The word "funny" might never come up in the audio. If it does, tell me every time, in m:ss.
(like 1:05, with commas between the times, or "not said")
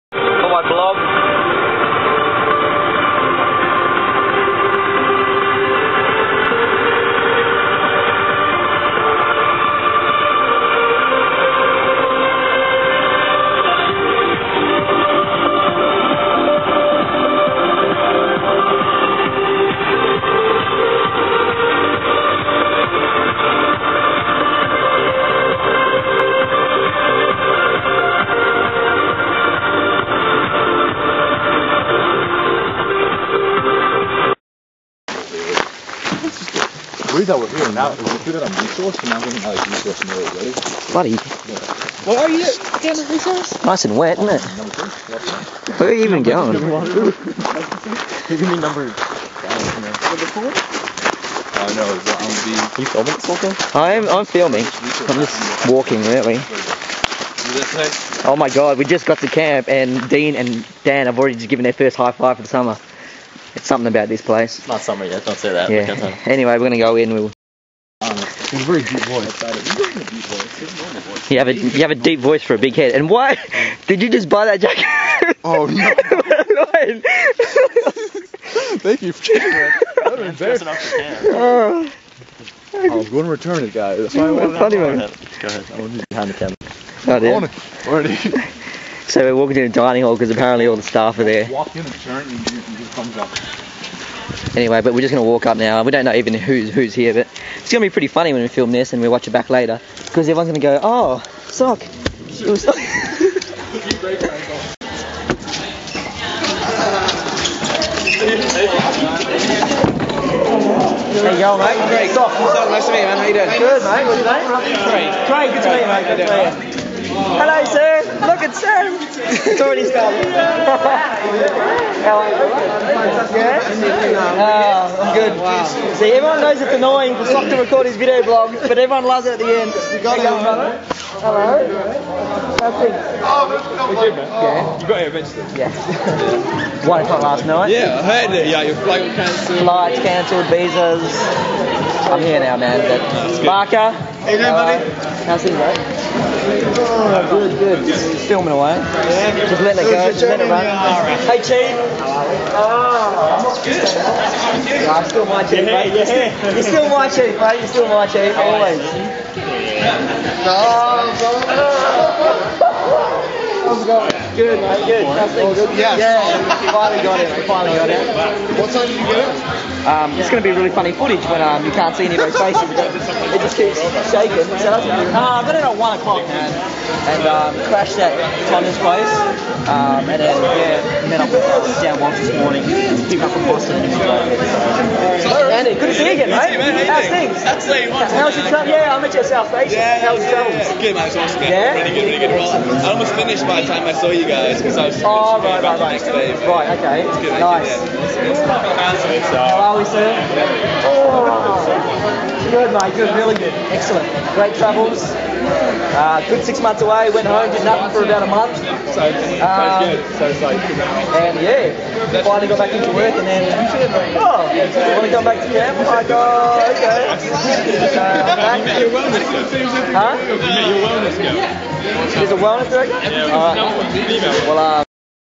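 1:38, 2:50.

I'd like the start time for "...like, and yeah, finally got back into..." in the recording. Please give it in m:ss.
3:30.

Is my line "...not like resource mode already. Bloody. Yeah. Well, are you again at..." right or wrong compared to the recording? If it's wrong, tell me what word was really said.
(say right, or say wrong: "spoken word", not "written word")
right.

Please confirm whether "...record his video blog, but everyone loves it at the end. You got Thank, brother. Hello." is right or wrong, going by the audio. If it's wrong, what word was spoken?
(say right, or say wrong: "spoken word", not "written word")
wrong: "Hello", not "Thank".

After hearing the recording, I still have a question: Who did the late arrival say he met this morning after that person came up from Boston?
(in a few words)
Dan Walsh.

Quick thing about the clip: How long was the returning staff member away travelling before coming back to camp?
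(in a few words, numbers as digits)
6 months.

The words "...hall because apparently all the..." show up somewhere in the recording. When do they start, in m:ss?
1:30.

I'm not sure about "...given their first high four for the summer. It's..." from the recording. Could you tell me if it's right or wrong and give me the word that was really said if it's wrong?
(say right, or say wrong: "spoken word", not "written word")
wrong: "five", not "four".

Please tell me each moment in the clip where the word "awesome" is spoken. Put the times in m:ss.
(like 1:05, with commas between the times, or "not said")
3:11.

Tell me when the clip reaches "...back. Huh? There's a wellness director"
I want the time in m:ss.
3:38.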